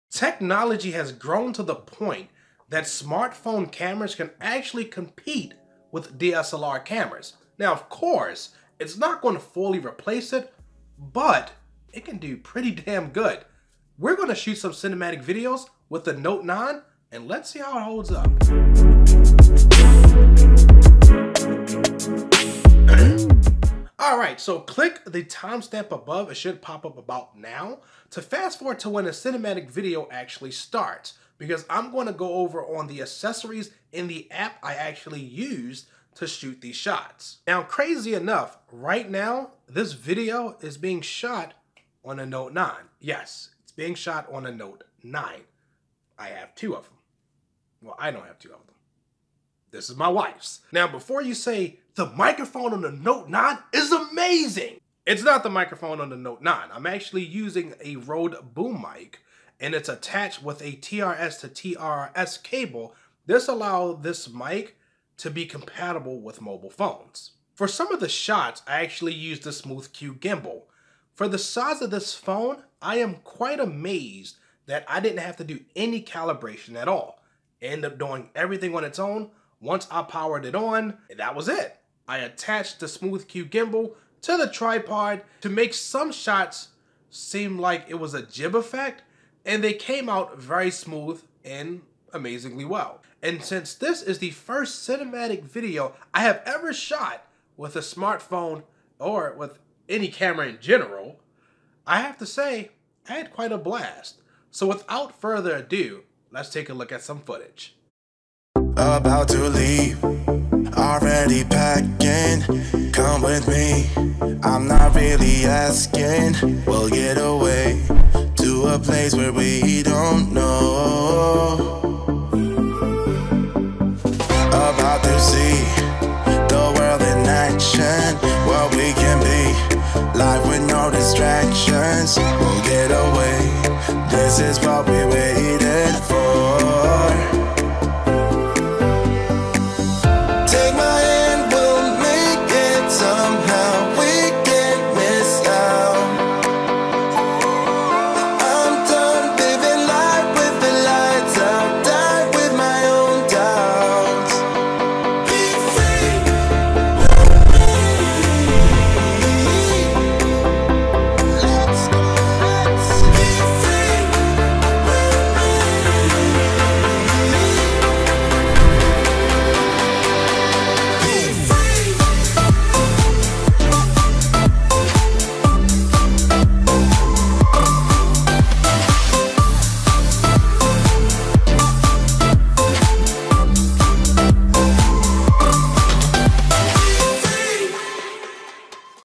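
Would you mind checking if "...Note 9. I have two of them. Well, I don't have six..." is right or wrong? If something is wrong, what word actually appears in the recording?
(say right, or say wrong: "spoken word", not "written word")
wrong: "two", not "six".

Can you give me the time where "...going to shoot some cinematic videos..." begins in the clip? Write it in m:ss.
0:14.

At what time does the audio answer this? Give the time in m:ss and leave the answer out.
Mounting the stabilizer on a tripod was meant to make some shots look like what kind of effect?
1:28.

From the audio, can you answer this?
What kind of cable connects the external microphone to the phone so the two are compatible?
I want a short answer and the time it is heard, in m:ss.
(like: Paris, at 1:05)
TRS to TRS cable, at 1:00.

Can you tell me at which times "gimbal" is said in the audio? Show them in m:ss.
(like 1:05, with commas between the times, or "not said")
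1:10, 1:23.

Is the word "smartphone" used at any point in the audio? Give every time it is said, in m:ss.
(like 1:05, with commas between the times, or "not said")
0:02, 1:37.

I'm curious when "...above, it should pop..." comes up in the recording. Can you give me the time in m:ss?
0:25.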